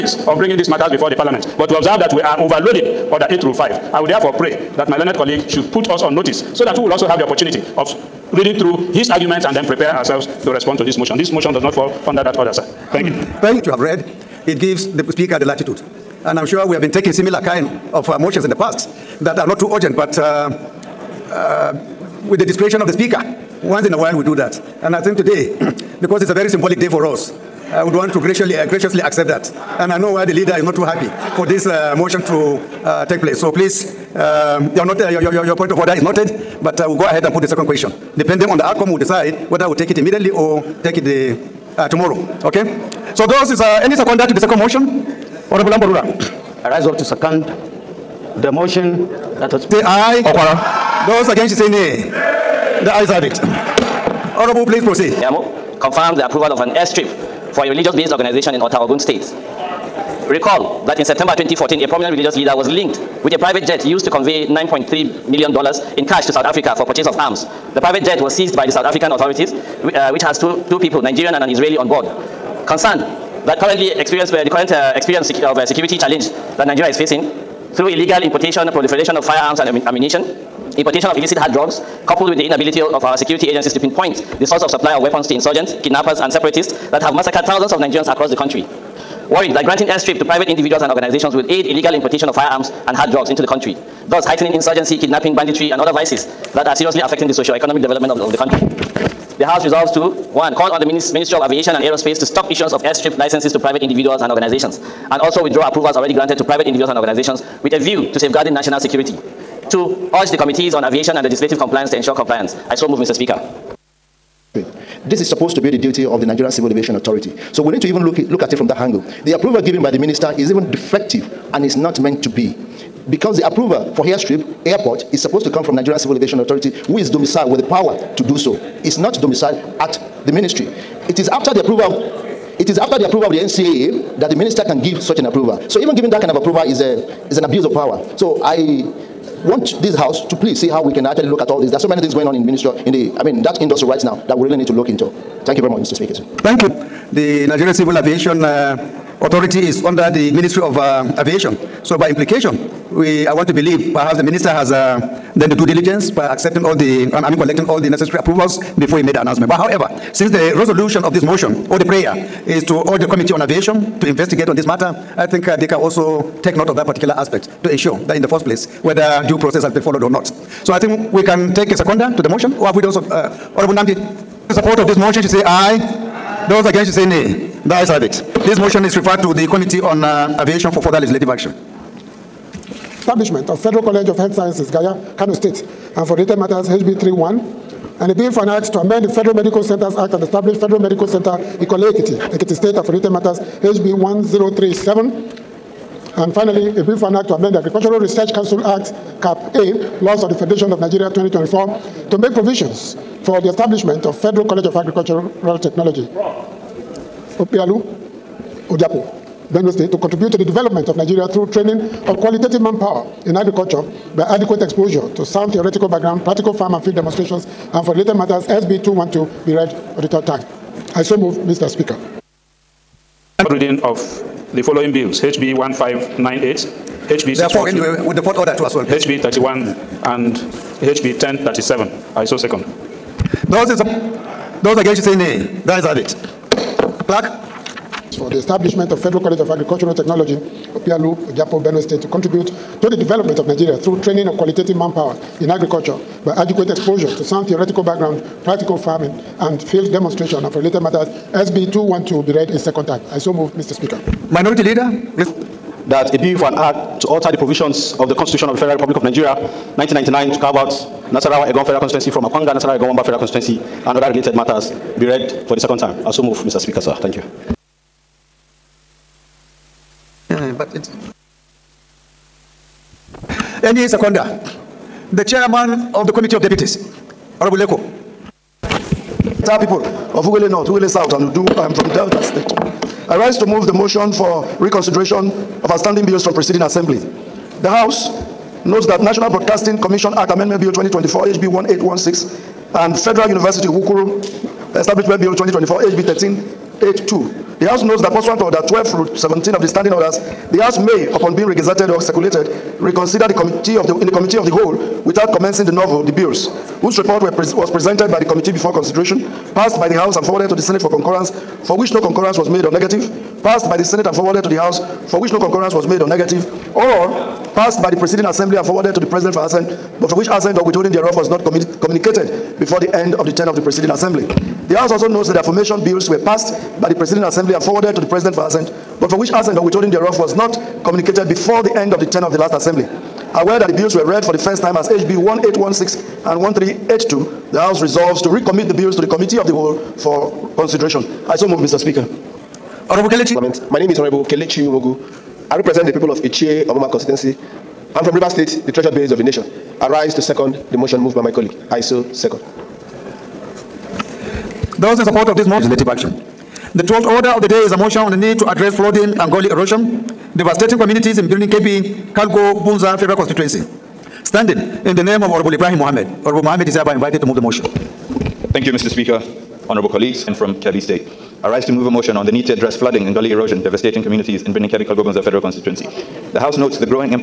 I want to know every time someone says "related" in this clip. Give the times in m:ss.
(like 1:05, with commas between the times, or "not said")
3:06, 3:37, 4:10, 4:24.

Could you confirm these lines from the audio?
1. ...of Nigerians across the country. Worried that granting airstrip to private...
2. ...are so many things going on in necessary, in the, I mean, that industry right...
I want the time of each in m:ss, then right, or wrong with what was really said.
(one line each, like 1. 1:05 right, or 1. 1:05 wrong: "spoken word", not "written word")
1. 1:27 right
2. 2:21 wrong: "ministry", not "necessary".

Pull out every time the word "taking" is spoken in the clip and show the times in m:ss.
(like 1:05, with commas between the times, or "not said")
0:16.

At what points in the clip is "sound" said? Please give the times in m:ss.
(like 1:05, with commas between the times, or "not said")
3:35, 4:07.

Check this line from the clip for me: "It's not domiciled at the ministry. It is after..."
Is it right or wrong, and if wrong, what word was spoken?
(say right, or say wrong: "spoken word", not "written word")
right.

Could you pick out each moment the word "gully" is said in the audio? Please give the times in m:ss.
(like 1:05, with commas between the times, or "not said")
5:59, 6:13.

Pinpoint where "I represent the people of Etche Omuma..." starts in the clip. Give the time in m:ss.
5:45.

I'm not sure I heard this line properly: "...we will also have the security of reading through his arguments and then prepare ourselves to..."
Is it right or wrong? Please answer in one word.
wrong.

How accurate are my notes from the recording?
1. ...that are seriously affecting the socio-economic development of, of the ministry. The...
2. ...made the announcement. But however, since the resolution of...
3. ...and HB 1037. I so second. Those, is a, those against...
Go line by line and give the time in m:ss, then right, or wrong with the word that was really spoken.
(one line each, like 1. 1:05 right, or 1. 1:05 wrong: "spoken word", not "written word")
1. 1:36 wrong: "country", not "ministry"
2. 2:39 right
3. 3:50 right.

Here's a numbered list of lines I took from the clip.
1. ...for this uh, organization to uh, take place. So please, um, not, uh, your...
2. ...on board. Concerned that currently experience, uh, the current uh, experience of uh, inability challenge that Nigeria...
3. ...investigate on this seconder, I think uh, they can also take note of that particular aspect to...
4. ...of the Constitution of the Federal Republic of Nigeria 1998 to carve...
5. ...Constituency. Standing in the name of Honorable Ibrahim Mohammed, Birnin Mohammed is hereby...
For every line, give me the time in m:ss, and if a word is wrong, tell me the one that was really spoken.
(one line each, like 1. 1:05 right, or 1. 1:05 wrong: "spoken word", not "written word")
1. 0:31 wrong: "motion", not "organization"
2. 1:11 wrong: "security", not "inability"
3. 2:44 wrong: "matter", not "seconder"
4. 4:17 wrong: "1999", not "1998"
5. 6:03 wrong: "Honorable", not "Birnin".